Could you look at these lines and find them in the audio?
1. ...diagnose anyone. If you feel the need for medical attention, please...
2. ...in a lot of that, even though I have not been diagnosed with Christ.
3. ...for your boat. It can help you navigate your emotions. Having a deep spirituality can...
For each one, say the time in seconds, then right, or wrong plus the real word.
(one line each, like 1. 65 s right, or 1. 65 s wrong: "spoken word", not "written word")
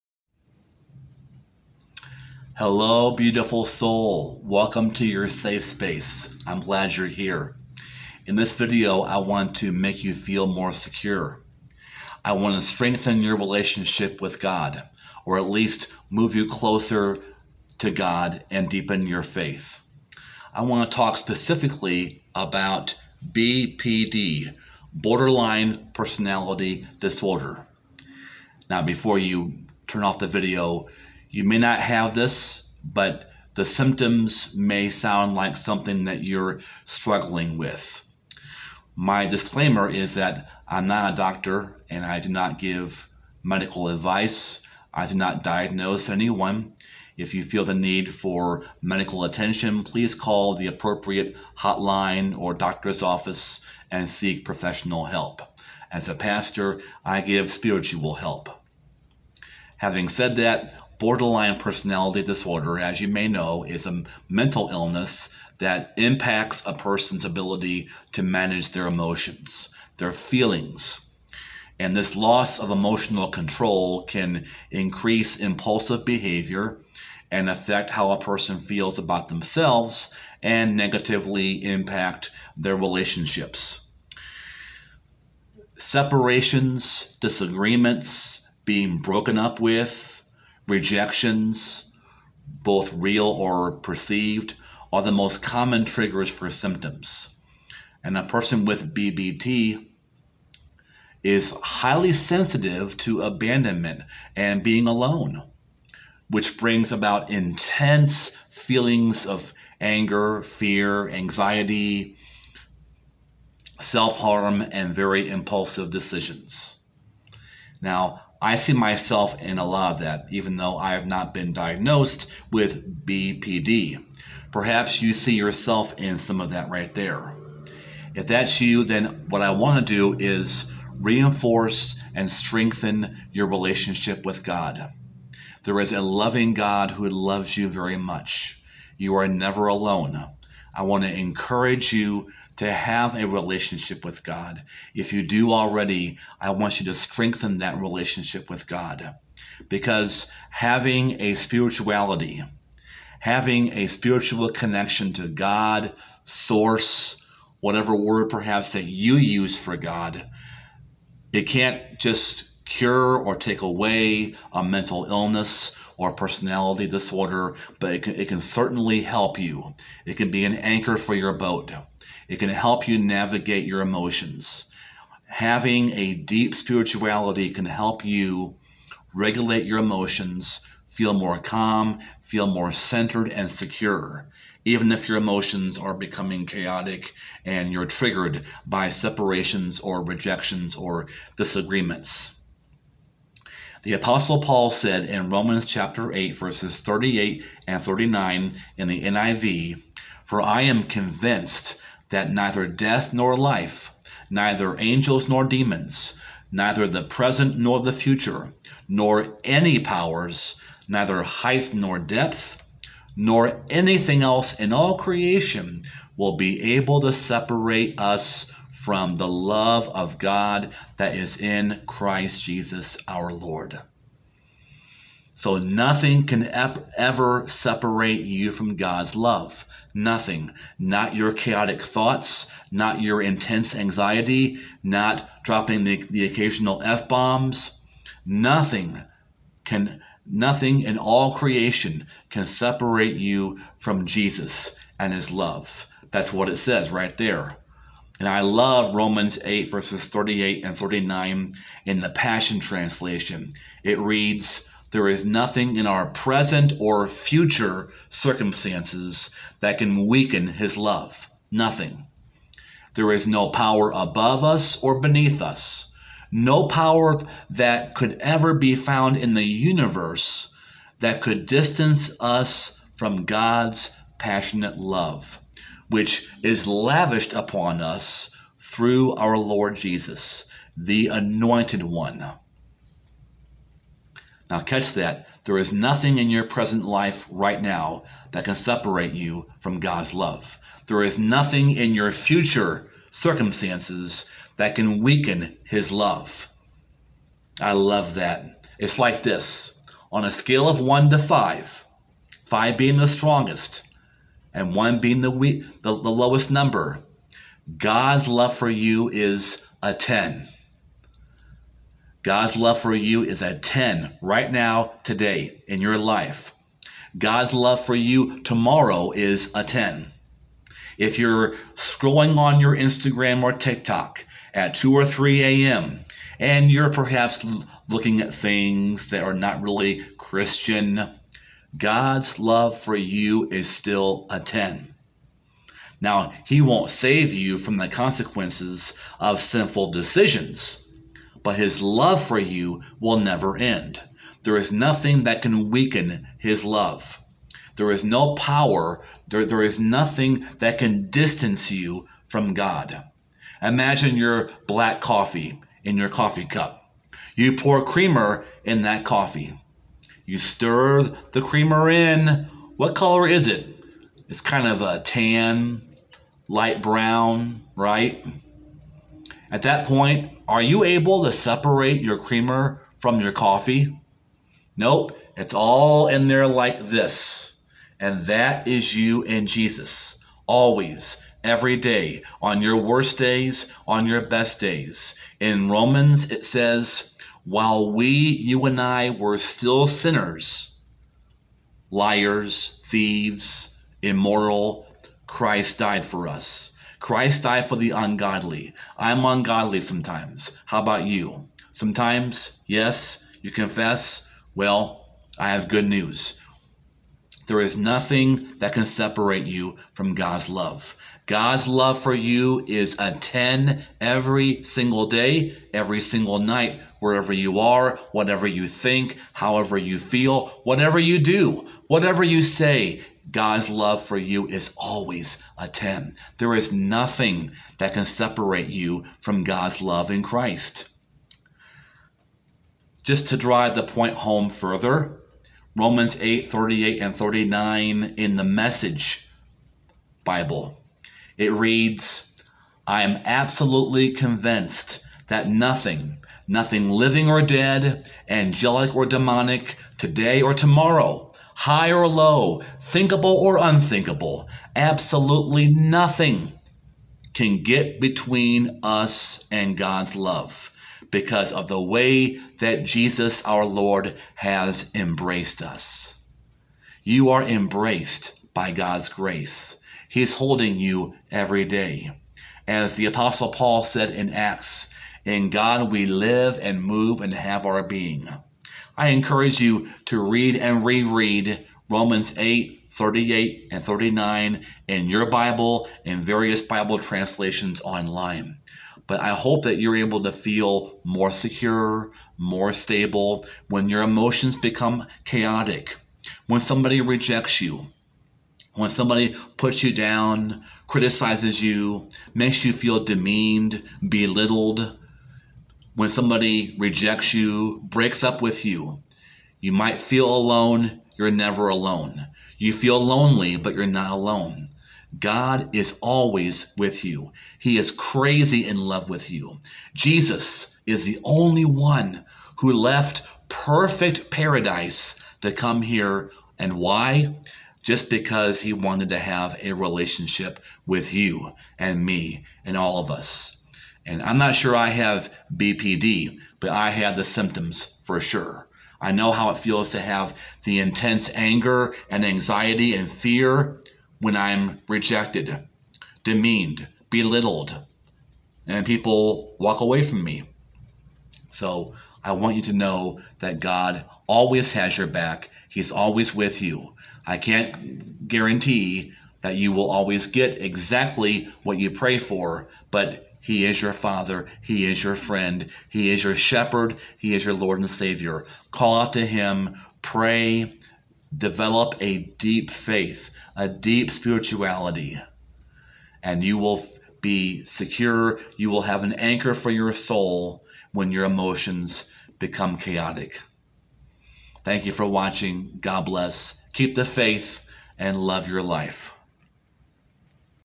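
1. 45 s right
2. 119 s wrong: "BPD", not "Christ"
3. 170 s right.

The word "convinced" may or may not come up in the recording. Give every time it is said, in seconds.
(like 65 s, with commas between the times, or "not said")
200 s, 444 s.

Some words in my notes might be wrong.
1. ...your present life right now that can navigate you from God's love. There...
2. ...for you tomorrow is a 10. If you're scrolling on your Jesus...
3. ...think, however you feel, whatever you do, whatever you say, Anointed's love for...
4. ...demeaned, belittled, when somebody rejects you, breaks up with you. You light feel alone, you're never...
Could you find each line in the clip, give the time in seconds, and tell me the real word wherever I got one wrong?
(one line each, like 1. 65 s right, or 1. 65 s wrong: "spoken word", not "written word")
1. 286 s wrong: "separate", not "navigate"
2. 317 s wrong: "Instagram", not "Jesus"
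3. 418 s wrong: "God", not "Anointed"
4. 503 s wrong: "might", not "light".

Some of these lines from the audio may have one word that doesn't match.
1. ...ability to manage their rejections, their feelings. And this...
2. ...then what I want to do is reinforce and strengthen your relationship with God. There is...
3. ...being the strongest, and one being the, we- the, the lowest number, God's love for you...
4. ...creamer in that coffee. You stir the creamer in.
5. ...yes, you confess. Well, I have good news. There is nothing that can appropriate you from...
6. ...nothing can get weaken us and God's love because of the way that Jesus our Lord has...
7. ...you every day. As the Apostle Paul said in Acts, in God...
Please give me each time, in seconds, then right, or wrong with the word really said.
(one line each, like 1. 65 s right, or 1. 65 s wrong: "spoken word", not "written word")
1. 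67 s wrong: "emotions", not "rejections"
2. 128 s right
3. 302 s right
4. 357 s right
5. 402 s wrong: "separate", not "appropriate"
6. 455 s wrong: "between", not "weaken"
7. 470 s right.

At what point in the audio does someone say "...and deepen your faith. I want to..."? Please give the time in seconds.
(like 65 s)
18 s.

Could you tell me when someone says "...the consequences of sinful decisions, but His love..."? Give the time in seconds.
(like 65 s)
337 s.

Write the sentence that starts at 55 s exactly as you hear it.
As a pastor, I give spiritual help.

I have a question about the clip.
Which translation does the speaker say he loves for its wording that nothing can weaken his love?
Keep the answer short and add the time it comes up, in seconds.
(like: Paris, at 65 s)
Passion Translation, at 252 s.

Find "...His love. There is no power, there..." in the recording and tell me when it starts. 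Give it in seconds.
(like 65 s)
346 s.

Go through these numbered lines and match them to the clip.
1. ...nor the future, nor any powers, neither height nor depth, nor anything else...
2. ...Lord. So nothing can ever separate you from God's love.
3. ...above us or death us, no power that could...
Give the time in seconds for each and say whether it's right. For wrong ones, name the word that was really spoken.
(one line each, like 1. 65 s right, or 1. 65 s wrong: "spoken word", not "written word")
1. 207 s right
2. 223 s right
3. 263 s wrong: "beneath", not "death".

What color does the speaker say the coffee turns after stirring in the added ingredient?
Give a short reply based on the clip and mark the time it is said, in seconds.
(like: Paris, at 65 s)
Tan, at 365 s.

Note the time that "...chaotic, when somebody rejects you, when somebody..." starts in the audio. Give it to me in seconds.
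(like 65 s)
495 s.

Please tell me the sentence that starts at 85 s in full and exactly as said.
Separations, disagreements, being broken up with, Rejections, both real or perceived, are the most common triggers for symptoms.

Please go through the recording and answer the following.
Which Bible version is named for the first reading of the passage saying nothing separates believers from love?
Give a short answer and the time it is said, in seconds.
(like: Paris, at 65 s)
NIV, at 199 s.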